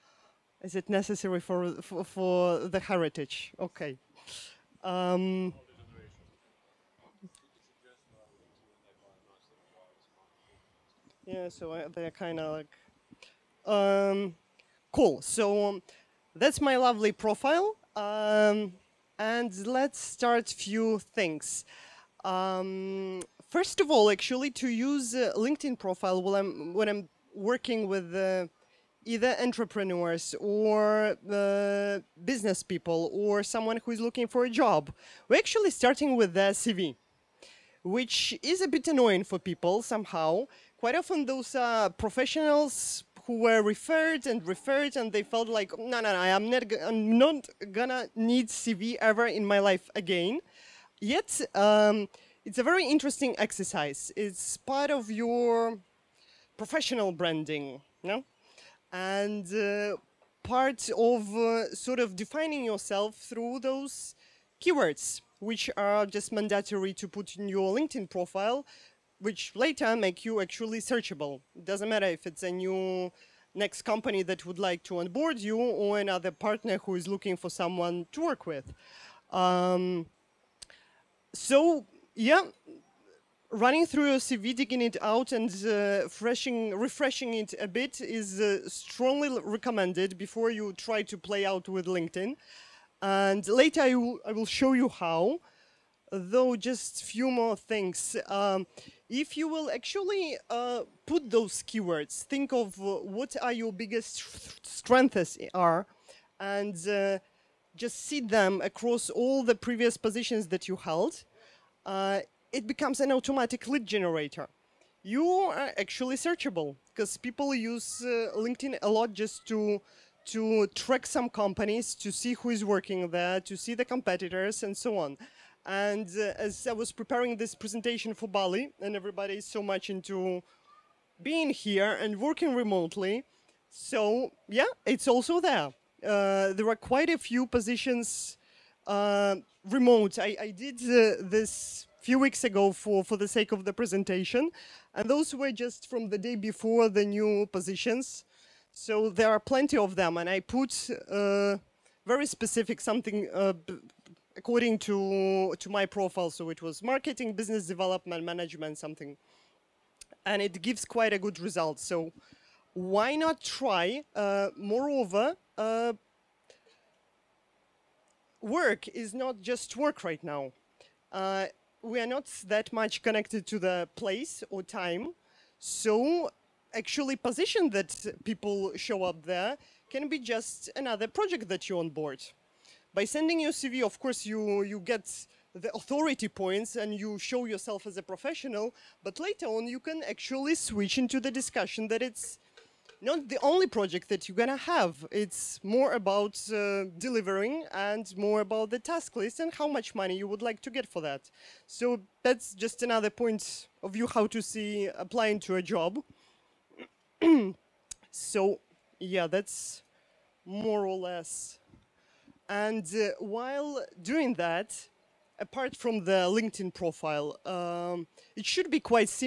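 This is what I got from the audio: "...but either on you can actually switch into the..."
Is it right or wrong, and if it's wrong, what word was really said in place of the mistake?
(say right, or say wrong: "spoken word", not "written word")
wrong: "later", not "either".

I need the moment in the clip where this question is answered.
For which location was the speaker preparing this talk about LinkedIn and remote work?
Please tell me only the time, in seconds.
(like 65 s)
128 s.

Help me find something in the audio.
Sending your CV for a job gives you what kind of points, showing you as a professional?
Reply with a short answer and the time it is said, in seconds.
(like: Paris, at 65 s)
Authority points, at 185 s.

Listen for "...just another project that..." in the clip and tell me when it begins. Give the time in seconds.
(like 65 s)
180 s.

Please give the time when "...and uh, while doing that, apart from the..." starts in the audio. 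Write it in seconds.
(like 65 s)
212 s.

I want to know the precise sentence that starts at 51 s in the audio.
Yet um, it's a very interesting exercise.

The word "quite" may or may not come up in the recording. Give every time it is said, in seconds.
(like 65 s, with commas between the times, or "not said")
40 s, 136 s, 160 s.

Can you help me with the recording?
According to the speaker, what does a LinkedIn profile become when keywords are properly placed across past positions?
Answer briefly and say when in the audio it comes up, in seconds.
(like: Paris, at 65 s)
Lead generator, at 113 s.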